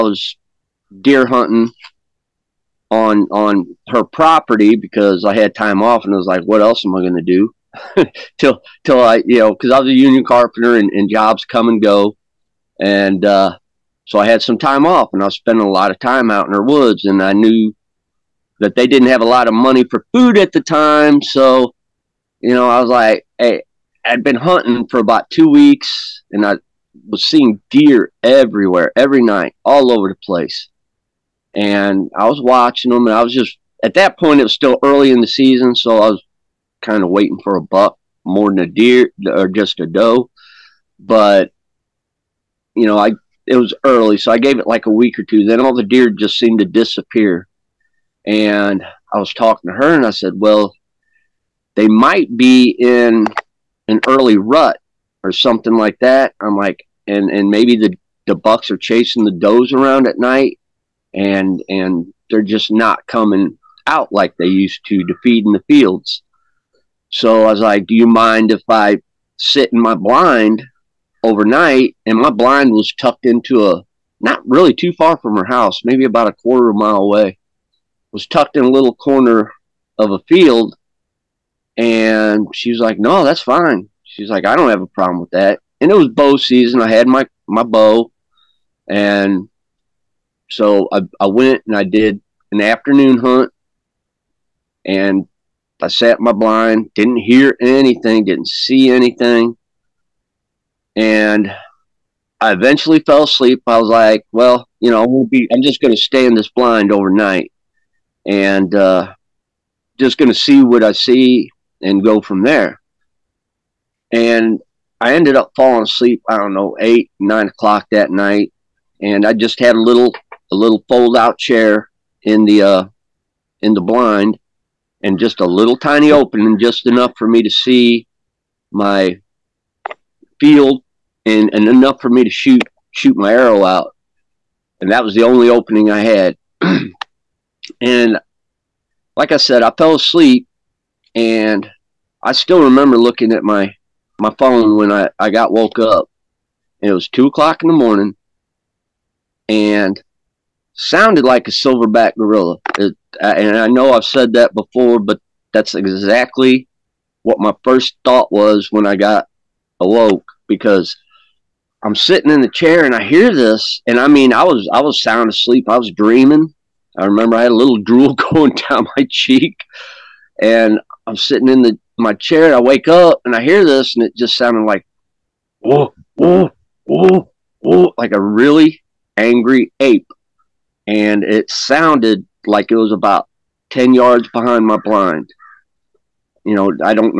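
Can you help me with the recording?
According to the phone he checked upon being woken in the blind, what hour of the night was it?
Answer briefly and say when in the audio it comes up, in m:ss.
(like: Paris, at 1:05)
2 a.m., at 2:27.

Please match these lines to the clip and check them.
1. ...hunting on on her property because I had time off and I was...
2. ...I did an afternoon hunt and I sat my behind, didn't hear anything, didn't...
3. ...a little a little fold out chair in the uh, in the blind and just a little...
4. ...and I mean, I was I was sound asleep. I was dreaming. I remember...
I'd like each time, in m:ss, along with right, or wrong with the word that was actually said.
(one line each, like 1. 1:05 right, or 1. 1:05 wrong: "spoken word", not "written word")
1. 0:01 right
2. 1:31 wrong: "blind", not "behind"
3. 1:59 right
4. 2:43 right.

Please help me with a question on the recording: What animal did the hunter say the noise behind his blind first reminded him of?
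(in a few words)
Silverback gorilla.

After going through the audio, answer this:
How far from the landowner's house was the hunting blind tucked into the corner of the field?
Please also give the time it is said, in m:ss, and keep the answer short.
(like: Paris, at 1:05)
A quarter of a mile, at 1:16.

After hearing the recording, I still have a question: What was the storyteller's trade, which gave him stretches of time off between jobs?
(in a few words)
Union carpenter.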